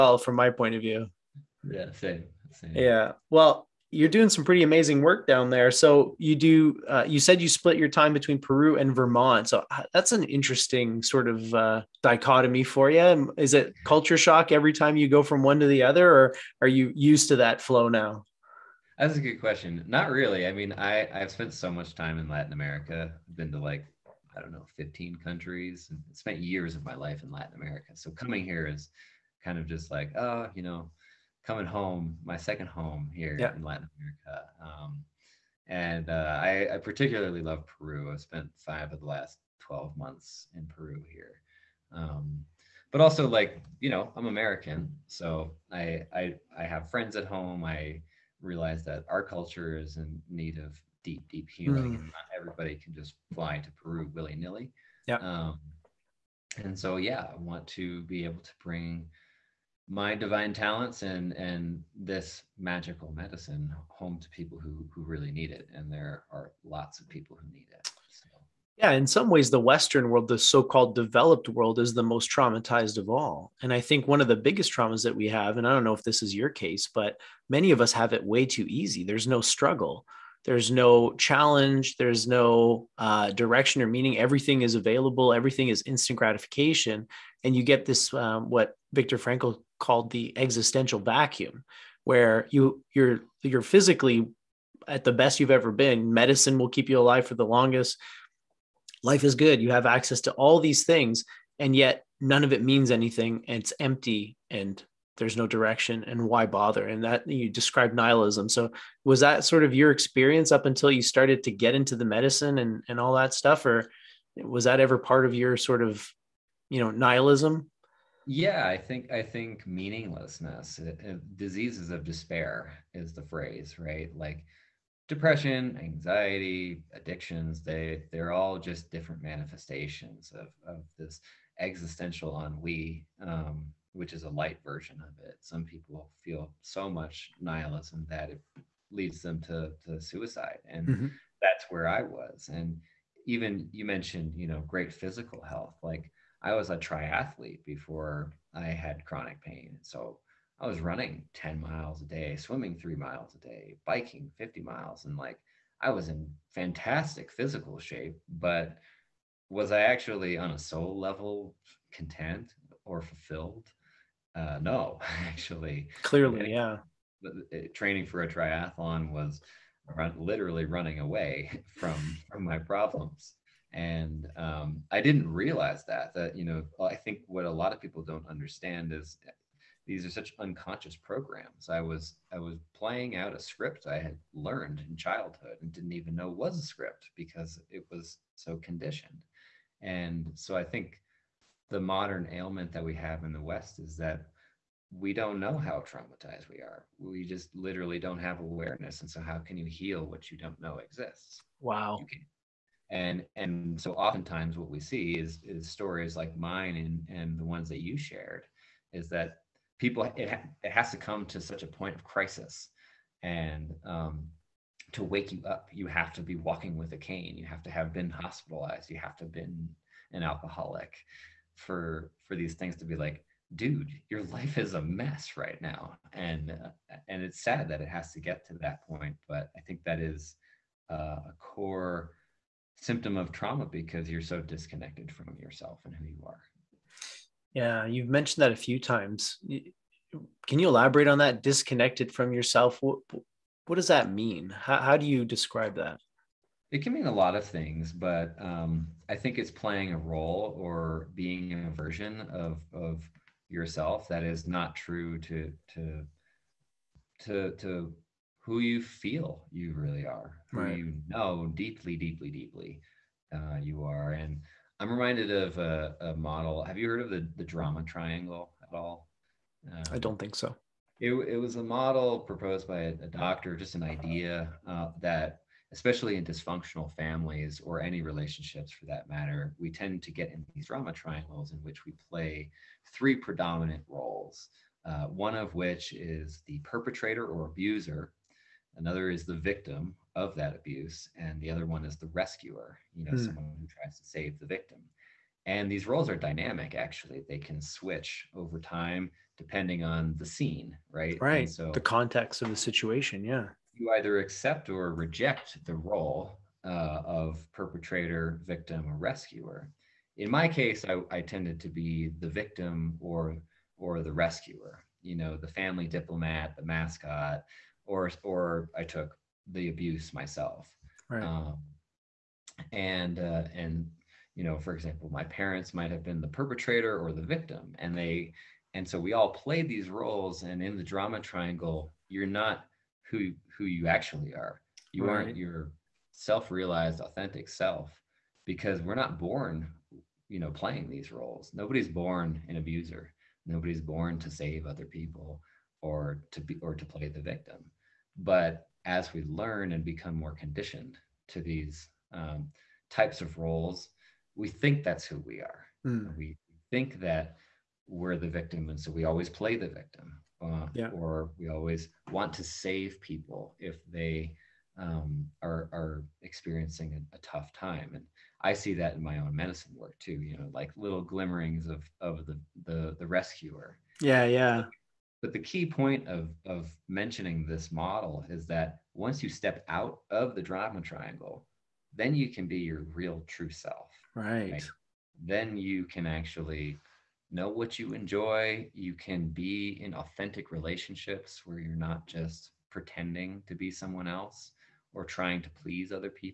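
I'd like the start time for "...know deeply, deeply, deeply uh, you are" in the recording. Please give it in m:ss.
4:21.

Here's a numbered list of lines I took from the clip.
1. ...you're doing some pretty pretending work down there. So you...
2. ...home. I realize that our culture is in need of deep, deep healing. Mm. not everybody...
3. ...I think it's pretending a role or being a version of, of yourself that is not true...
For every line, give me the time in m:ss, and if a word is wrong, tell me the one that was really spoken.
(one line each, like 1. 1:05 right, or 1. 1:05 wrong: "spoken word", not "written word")
1. 0:03 wrong: "amazing", not "pretending"
2. 0:47 right
3. 4:09 wrong: "playing", not "pretending".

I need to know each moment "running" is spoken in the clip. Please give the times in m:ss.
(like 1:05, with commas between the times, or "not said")
2:30, 2:50.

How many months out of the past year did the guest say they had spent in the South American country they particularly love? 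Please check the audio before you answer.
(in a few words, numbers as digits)
5.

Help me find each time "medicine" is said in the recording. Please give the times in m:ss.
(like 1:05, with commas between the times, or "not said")
1:03, 1:36, 1:52, 6:09.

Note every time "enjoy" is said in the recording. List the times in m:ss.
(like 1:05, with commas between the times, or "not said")
6:27.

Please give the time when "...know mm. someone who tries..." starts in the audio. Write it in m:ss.
4:53.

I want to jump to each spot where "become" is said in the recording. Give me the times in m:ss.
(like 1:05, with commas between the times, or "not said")
5:49.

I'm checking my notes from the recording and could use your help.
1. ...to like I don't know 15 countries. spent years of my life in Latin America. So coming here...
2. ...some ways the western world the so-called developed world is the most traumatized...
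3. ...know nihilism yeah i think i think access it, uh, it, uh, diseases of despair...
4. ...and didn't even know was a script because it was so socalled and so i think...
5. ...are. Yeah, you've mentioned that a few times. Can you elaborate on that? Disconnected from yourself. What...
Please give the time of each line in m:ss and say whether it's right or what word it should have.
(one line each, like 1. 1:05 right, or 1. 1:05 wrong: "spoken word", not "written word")
1. 0:23 right
2. 1:09 right
3. 1:56 wrong: "meaninglessness", not "access"
4. 3:05 wrong: "conditioned", not "socalled"
5. 3:56 right.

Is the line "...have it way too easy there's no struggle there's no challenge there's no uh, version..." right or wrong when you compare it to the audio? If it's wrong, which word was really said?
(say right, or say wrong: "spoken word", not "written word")
wrong: "direction", not "version".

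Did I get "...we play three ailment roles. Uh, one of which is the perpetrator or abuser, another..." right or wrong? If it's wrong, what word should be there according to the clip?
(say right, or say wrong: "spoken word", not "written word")
wrong: "predominant", not "ailment".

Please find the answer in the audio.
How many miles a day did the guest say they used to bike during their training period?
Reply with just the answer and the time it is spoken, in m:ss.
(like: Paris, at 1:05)
50, at 2:34.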